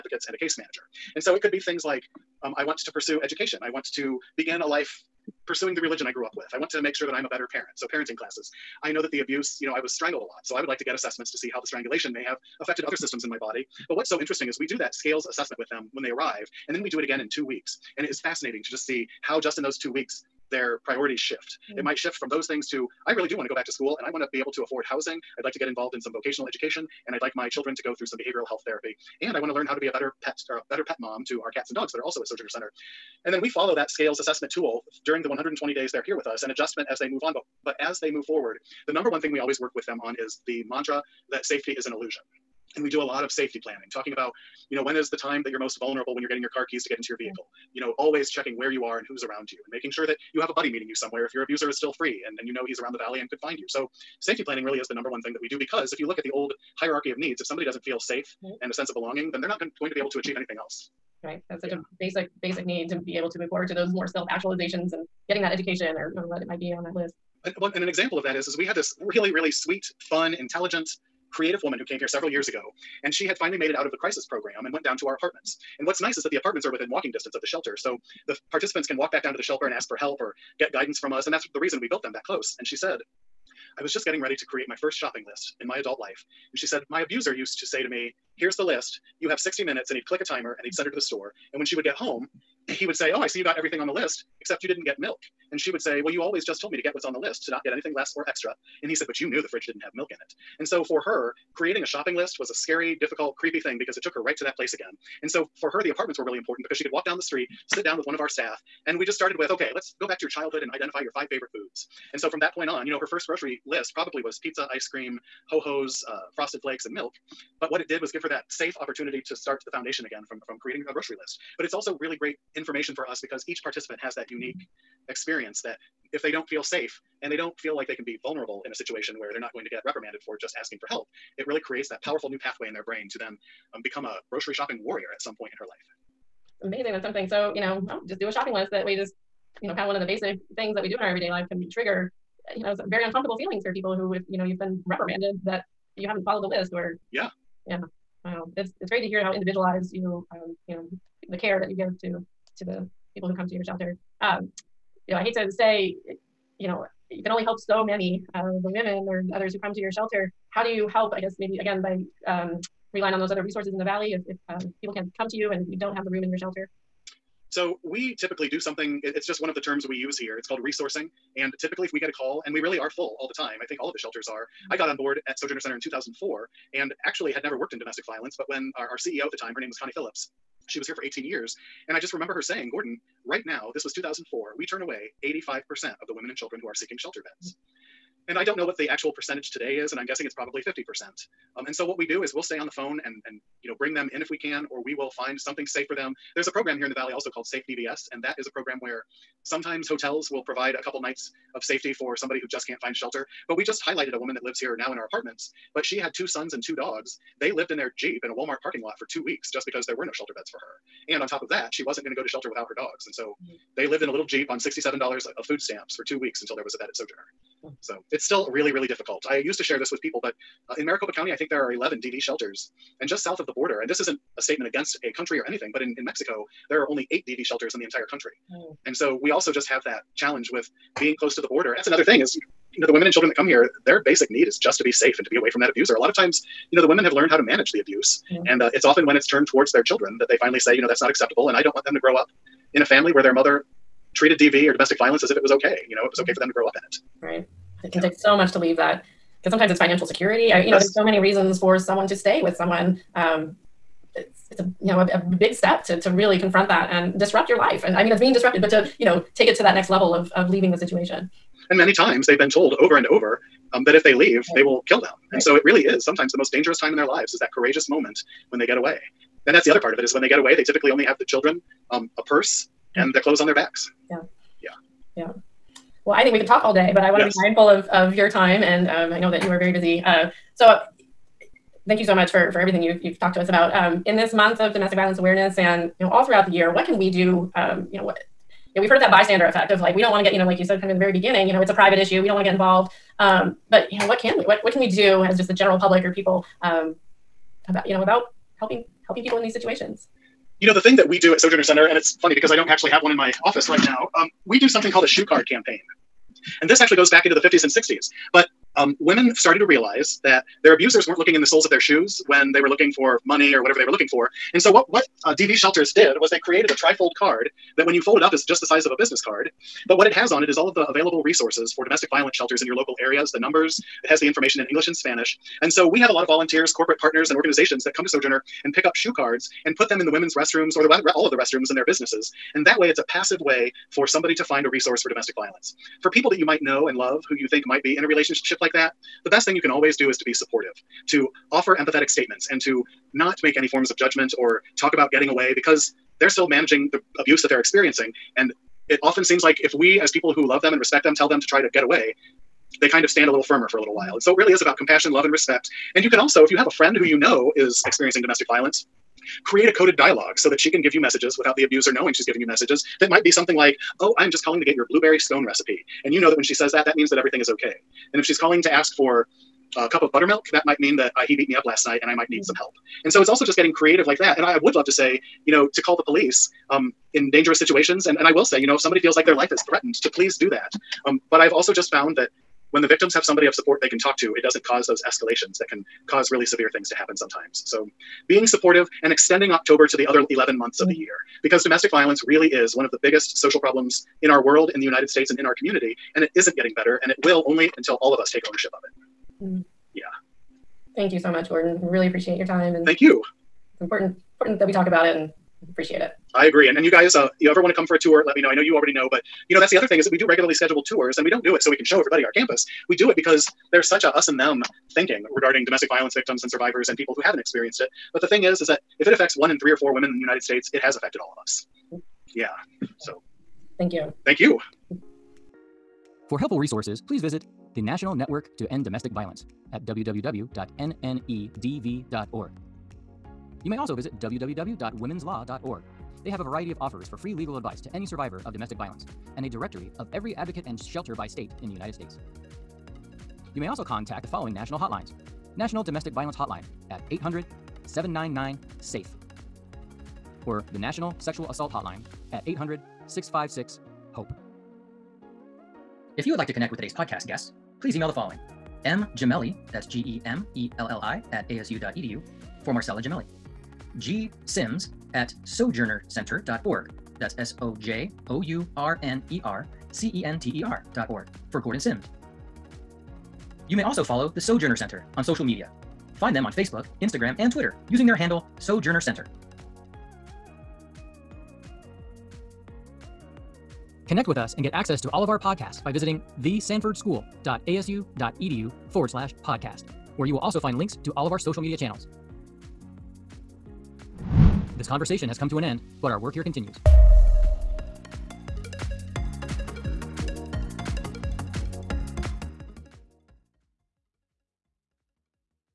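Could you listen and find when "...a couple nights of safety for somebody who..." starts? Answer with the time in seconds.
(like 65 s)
200 s.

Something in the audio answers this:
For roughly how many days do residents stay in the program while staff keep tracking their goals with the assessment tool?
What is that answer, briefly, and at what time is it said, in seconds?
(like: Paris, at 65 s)
120, at 35 s.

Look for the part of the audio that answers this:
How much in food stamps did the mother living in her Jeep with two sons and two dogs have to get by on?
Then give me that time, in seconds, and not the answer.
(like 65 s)
214 s.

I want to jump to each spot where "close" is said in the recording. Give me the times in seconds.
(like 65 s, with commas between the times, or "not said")
82 s, 231 s.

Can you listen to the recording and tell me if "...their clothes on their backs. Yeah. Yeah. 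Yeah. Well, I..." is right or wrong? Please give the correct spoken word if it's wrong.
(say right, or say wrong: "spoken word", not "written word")
right.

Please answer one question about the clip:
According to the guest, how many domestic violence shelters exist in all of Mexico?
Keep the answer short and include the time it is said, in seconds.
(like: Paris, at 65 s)
8, at 227 s.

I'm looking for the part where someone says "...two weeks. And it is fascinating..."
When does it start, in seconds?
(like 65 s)
17 s.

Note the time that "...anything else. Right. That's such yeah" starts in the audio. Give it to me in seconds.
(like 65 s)
60 s.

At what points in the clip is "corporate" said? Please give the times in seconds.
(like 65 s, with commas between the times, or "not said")
326 s.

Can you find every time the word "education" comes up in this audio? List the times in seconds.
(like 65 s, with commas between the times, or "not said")
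3 s, 26 s, 65 s.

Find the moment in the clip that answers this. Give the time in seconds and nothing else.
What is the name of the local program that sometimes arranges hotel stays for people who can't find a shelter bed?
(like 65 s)
197 s.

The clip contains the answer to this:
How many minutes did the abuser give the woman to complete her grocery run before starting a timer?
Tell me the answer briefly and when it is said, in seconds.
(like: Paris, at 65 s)
60, at 89 s.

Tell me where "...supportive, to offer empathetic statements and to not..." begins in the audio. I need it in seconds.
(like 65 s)
340 s.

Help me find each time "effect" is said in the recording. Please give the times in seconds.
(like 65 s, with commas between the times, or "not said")
289 s.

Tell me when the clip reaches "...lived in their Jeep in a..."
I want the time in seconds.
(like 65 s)
207 s.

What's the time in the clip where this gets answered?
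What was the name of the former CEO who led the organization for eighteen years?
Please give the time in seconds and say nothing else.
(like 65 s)
179 s.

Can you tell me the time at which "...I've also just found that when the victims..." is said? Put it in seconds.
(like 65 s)
381 s.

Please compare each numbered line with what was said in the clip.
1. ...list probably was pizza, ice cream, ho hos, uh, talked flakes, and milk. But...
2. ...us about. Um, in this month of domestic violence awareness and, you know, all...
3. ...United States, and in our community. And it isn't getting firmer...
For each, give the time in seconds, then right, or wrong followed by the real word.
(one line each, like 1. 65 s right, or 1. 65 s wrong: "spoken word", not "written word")
1. 113 s wrong: "frosted", not "talked"
2. 283 s right
3. 394 s wrong: "better", not "firmer".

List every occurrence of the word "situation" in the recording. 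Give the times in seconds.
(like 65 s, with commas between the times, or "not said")
128 s, 260 s, 299 s, 377 s.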